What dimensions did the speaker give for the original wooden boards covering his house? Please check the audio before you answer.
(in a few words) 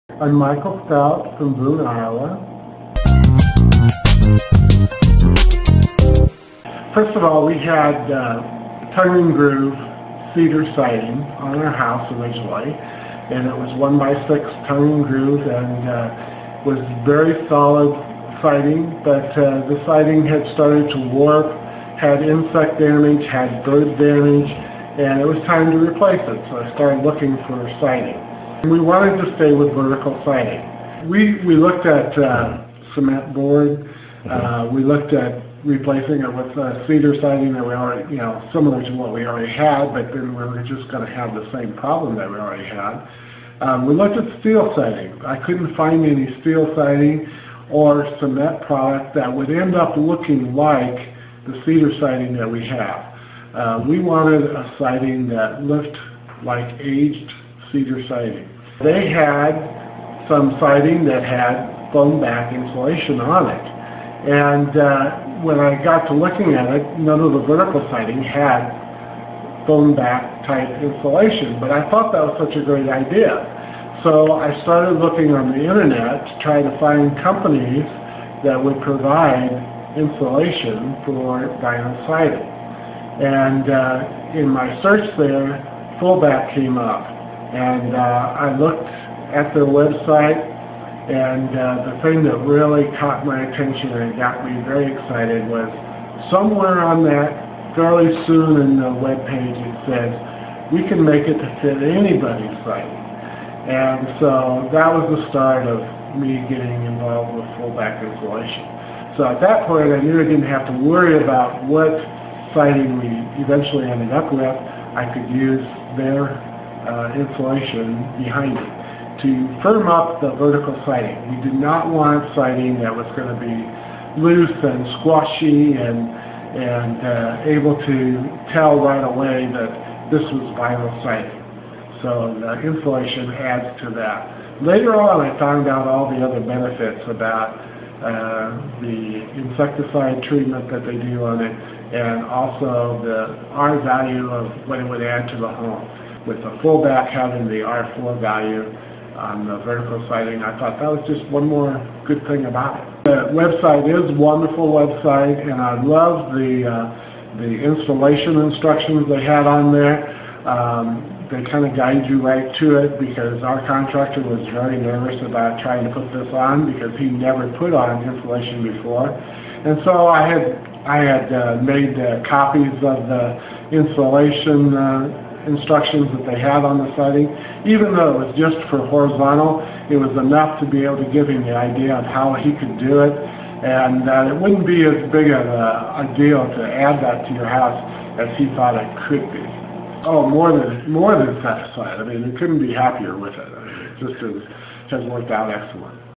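1 by 6.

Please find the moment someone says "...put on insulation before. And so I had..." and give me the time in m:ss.
2:47.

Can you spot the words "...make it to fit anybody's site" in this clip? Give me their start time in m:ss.
1:41.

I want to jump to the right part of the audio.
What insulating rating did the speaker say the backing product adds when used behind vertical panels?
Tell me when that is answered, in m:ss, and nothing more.
2:27.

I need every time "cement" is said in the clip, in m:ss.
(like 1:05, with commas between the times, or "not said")
0:32, 0:48.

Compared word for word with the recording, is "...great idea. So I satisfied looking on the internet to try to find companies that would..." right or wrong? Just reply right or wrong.
wrong.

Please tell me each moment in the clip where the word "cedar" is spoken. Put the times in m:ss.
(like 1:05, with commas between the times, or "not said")
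0:10, 0:36, 0:51, 0:57.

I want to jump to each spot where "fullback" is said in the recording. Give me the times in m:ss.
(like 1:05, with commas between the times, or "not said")
1:25, 1:47, 2:26.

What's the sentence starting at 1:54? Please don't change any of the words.
I could use their uh, insulation behind it to firm up the vertical siding.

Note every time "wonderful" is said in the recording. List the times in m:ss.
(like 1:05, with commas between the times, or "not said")
2:34.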